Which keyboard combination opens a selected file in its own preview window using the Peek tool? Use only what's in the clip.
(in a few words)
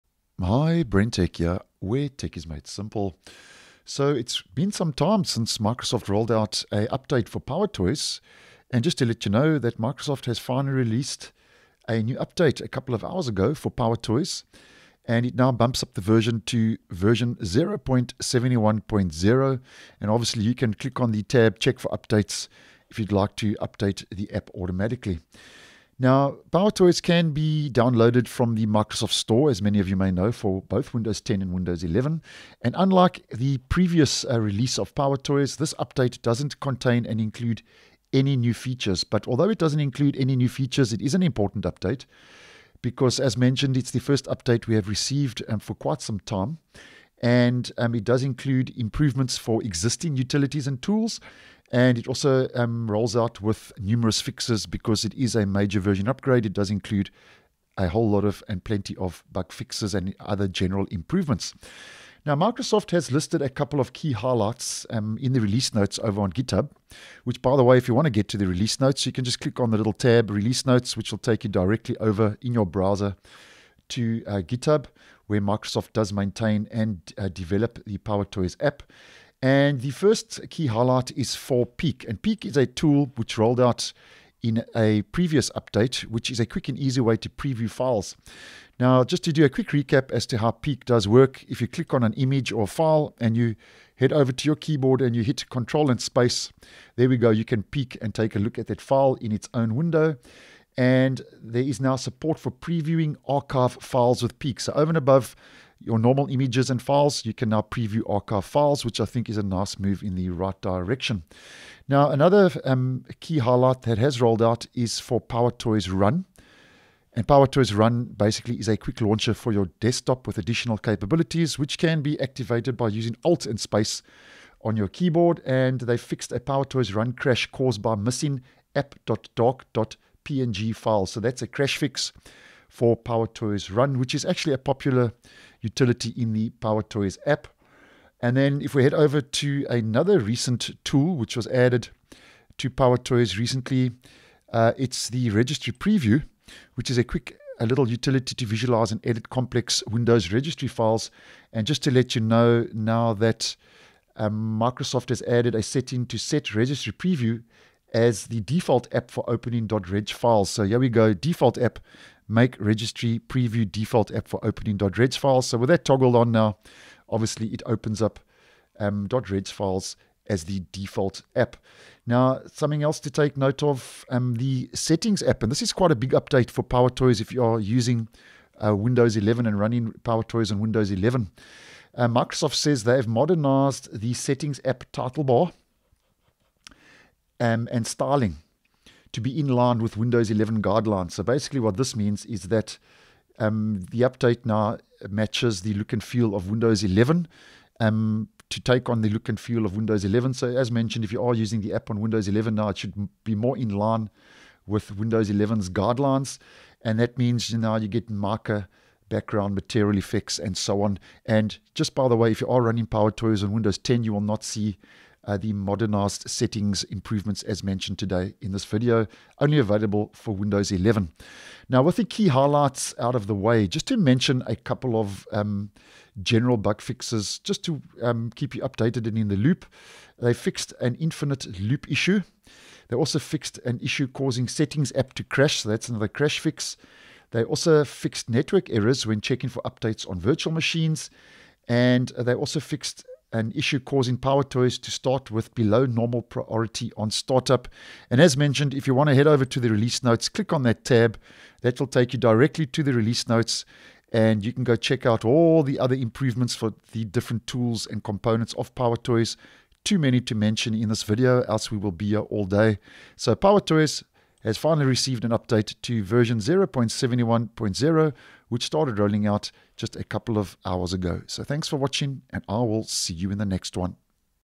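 Control and Space.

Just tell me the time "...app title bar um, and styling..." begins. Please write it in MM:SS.
03:04.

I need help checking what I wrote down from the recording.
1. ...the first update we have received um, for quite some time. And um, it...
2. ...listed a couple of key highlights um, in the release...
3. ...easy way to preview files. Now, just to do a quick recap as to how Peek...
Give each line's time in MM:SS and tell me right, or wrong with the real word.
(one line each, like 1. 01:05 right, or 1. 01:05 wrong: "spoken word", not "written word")
1. 00:43 right
2. 01:03 right
3. 01:26 right.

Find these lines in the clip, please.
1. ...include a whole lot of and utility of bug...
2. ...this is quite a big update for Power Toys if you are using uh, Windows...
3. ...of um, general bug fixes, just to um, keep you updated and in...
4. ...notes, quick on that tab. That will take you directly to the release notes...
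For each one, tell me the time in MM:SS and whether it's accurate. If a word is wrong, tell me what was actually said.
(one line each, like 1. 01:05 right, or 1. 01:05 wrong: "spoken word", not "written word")
1. 00:56 wrong: "plenty", not "utility"
2. 02:55 right
3. 03:44 right
4. 04:10 wrong: "click", not "quick".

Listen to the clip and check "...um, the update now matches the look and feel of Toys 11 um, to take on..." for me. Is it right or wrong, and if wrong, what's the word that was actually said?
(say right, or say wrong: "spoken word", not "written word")
wrong: "Windows", not "Toys".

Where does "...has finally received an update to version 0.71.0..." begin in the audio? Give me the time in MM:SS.
04:24.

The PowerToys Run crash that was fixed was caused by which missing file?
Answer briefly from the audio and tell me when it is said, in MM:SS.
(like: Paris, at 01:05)
app.dark.png, at 02:08.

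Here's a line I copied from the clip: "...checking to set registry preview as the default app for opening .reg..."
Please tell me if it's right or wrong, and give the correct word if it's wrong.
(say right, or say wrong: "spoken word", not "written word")
wrong: "setting", not "checking".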